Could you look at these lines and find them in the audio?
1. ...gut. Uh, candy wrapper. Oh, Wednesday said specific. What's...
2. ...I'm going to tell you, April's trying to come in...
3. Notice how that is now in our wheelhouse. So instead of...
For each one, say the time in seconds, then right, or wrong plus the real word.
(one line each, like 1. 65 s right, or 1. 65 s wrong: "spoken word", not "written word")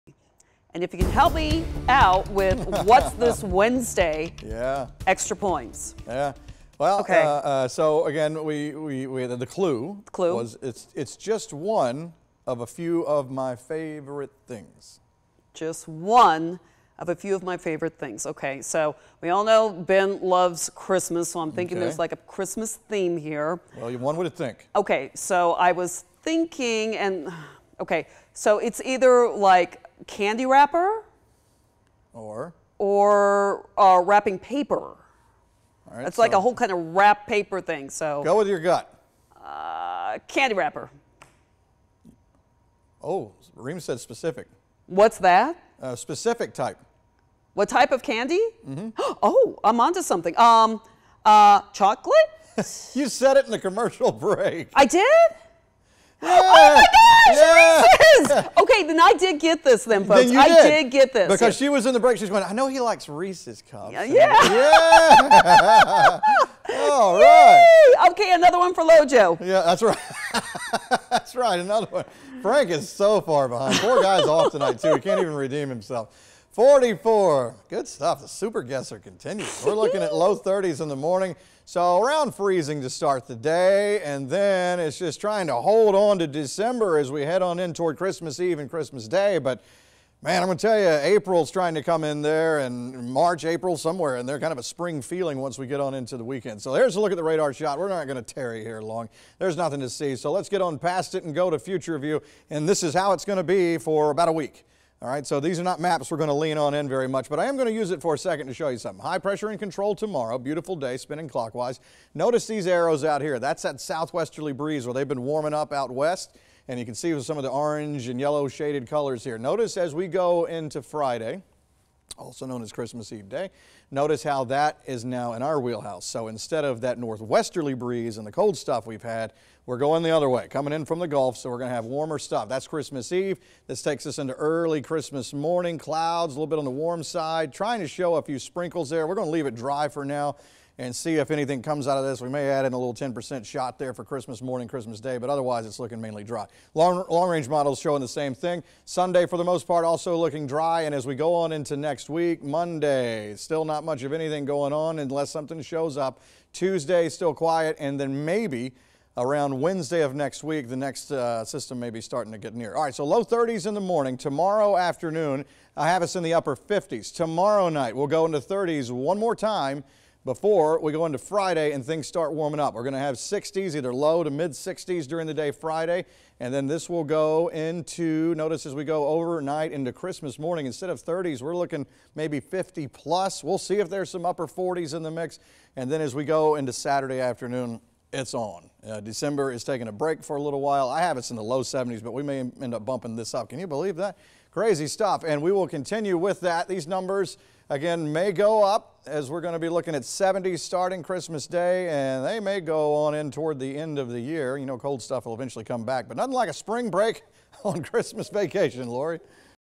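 1. 38 s wrong: "Reem", not "Wednesday"
2. 90 s right
3. 123 s right.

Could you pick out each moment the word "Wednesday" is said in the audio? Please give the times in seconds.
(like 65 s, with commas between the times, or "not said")
3 s, 159 s.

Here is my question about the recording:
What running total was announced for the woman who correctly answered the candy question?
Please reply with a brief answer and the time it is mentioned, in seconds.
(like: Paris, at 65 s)
44, at 76 s.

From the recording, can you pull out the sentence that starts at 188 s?
Uh, December is taking a break for a little while.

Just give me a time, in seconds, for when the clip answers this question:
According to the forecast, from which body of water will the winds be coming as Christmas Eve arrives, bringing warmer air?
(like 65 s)
130 s.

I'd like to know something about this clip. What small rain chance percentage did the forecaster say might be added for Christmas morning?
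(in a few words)
10%.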